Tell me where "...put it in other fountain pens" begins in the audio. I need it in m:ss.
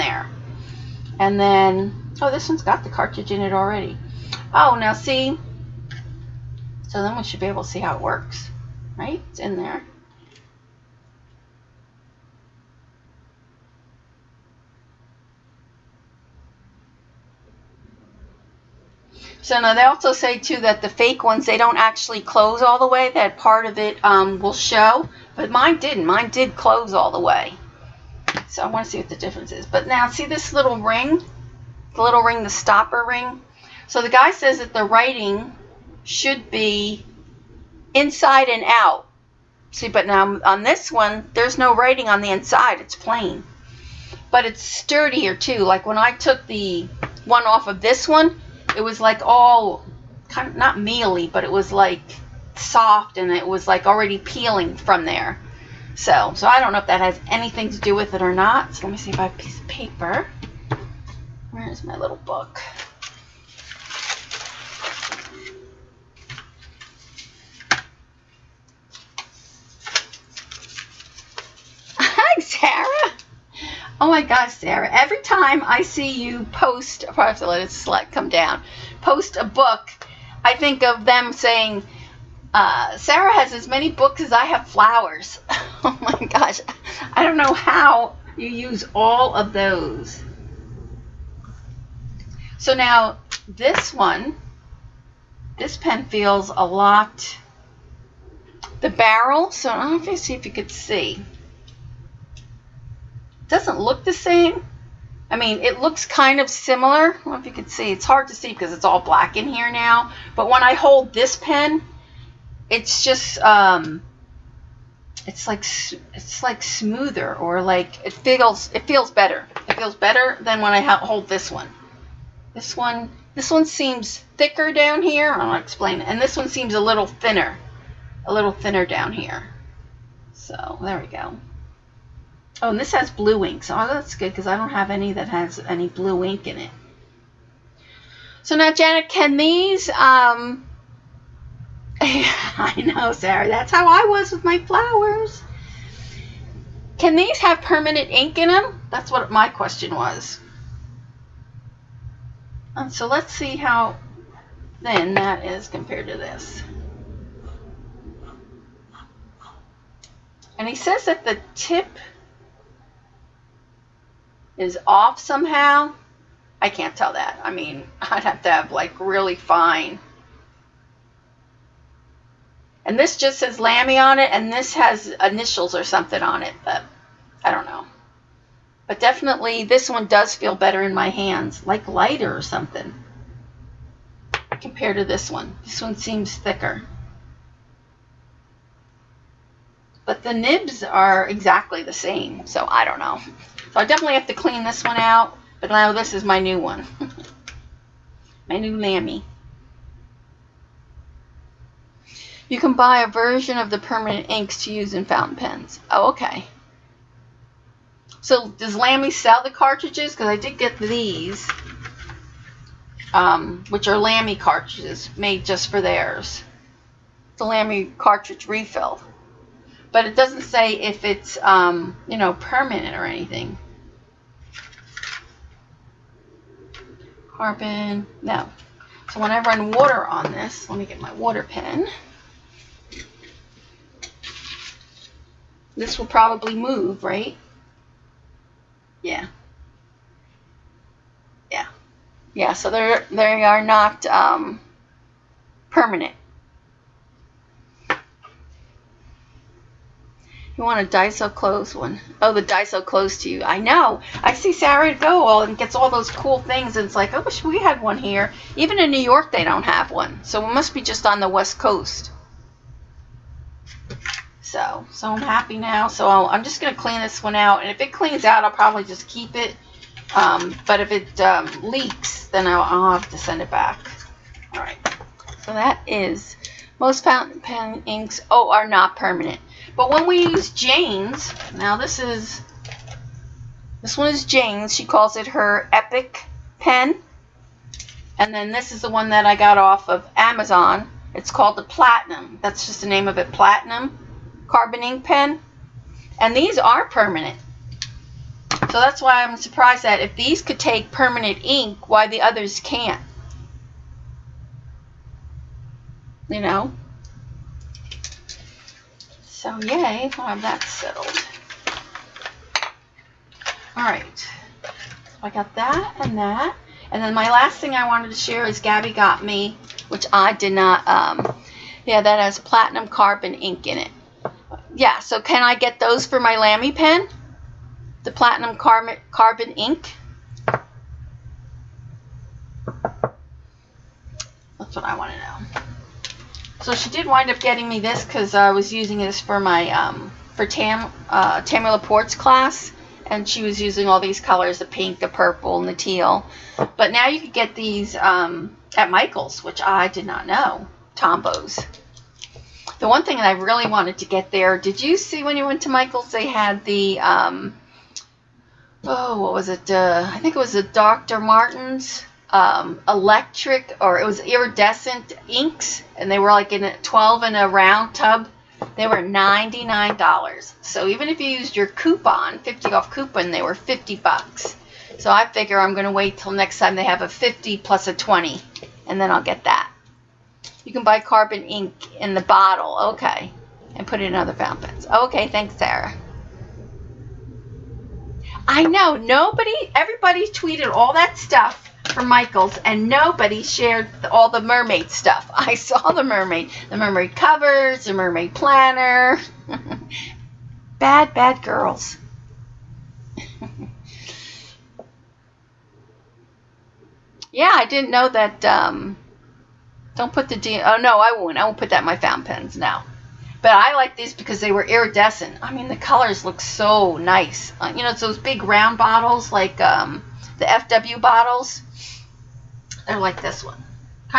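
6:23.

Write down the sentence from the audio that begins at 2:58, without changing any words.
But definitely, this one does feel better in my hands, like lighter or something, compared to this one.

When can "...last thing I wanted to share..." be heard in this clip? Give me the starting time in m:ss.
5:17.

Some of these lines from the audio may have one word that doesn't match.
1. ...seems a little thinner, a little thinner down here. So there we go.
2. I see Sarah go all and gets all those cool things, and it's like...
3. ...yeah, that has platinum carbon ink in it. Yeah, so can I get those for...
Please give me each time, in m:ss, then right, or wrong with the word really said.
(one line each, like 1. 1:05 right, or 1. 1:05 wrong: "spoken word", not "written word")
1. 2:06 right
2. 4:14 right
3. 5:21 right.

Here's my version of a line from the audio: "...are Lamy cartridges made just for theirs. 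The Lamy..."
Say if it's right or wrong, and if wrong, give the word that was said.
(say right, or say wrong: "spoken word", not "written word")
right.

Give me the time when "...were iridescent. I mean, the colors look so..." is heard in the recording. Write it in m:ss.
6:54.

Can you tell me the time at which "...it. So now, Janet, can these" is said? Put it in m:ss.
2:16.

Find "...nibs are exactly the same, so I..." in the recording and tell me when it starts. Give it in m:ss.
3:10.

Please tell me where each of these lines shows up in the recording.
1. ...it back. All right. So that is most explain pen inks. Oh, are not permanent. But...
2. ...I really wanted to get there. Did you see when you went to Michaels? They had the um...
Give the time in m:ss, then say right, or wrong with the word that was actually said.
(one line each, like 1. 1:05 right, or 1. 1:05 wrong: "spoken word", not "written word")
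1. 4:33 wrong: "fountain", not "explain"
2. 5:53 right.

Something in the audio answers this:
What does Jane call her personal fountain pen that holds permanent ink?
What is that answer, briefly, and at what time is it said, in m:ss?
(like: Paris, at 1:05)
Epic pen, at 4:45.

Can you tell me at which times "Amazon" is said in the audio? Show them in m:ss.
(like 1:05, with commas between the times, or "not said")
4:50.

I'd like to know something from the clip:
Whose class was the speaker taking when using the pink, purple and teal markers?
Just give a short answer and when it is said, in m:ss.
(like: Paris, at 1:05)
Tammy Laporte, at 5:41.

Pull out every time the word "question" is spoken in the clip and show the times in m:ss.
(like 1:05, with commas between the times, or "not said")
2:29.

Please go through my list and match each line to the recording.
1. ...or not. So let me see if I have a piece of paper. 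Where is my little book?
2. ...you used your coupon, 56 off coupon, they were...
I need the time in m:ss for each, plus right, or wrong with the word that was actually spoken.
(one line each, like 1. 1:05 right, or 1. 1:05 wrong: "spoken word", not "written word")
1. 0:58 right
2. 6:11 wrong: "50", not "56".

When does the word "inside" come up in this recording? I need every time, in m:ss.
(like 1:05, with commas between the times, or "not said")
0:37, 0:42.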